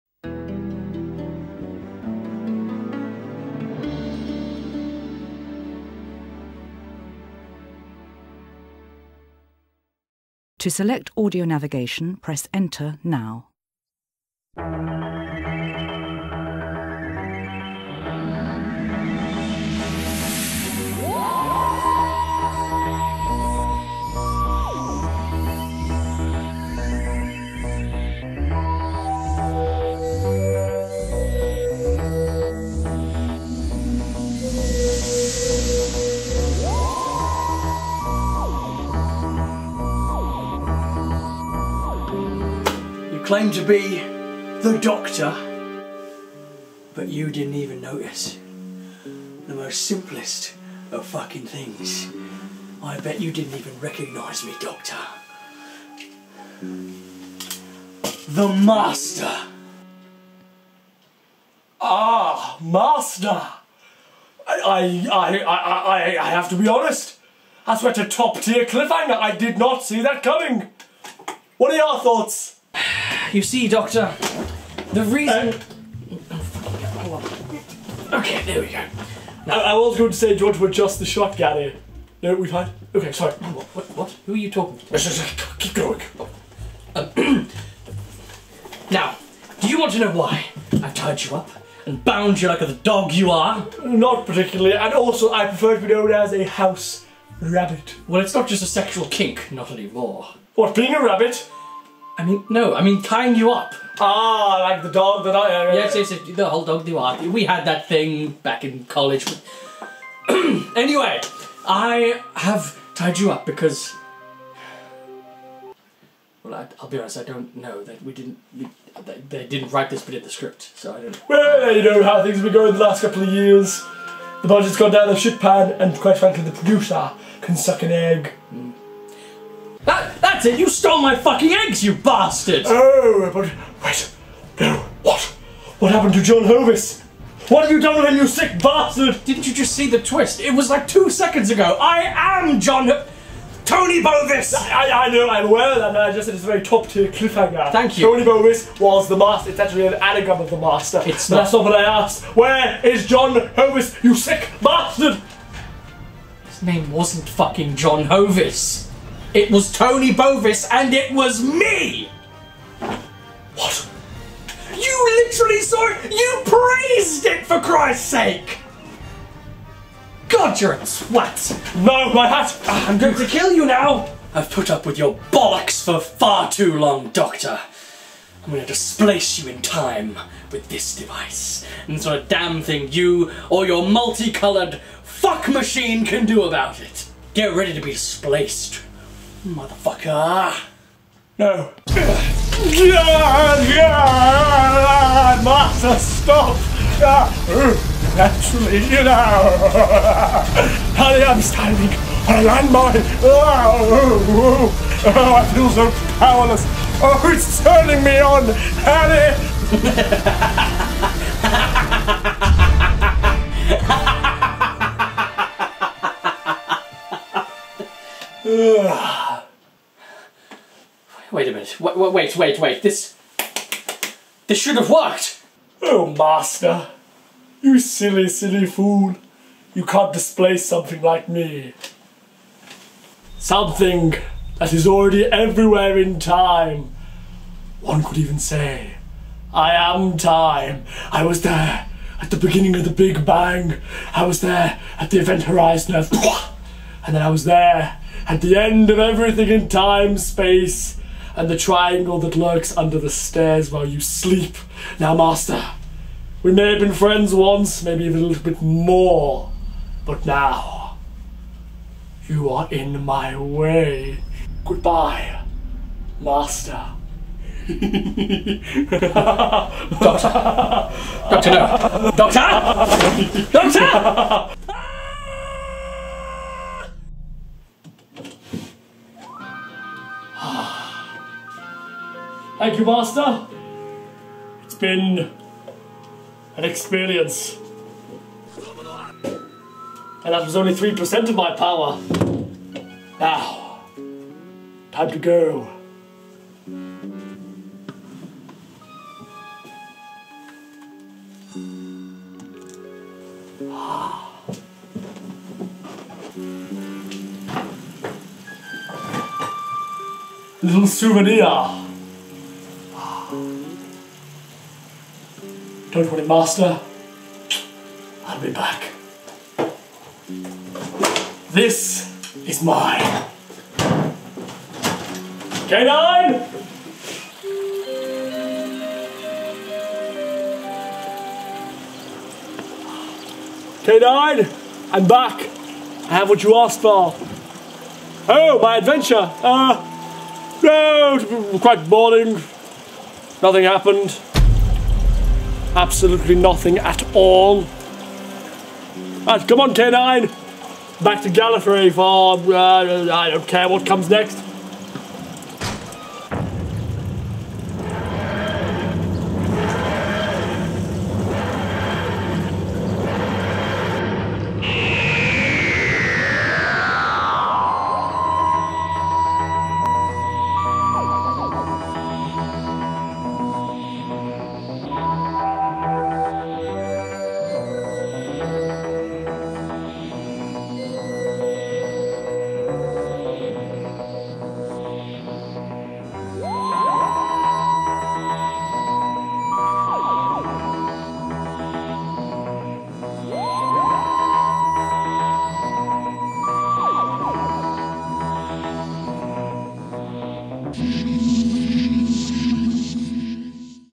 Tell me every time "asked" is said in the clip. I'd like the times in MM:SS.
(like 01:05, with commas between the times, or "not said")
02:31, 05:36.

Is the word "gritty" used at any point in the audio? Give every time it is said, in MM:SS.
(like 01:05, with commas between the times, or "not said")
not said.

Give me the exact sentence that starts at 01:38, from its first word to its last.
Well, it's not just a sexual kink, not anymore.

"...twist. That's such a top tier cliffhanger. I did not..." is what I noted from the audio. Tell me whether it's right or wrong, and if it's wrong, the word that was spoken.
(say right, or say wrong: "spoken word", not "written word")
wrong: "honest", not "twist".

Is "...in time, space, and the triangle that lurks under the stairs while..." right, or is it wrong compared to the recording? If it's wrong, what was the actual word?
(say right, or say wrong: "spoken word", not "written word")
right.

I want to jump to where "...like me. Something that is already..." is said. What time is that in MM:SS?
03:51.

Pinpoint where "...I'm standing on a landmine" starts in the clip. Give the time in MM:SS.
03:21.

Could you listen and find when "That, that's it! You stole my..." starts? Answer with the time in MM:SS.
02:09.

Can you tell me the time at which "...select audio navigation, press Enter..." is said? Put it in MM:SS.
00:10.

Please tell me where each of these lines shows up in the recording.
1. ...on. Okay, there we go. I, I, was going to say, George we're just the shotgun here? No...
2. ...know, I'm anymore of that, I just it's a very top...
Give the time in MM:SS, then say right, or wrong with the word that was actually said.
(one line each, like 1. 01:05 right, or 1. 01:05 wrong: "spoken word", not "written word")
1. 01:18 right
2. 02:25 wrong: "aware", not "anymore".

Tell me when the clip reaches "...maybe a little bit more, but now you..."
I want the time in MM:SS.
04:17.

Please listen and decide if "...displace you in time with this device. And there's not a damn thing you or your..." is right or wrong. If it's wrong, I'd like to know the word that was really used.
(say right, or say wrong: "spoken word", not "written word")
right.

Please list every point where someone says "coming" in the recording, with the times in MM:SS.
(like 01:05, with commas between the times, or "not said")
01:10.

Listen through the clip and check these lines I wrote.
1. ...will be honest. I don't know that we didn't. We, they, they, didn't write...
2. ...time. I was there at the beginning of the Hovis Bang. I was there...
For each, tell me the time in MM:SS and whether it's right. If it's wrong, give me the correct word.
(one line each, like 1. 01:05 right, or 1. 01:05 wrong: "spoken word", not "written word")
1. 01:56 right
2. 04:00 wrong: "Big", not "Hovis".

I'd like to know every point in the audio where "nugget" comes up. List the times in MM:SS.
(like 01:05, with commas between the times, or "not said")
not said.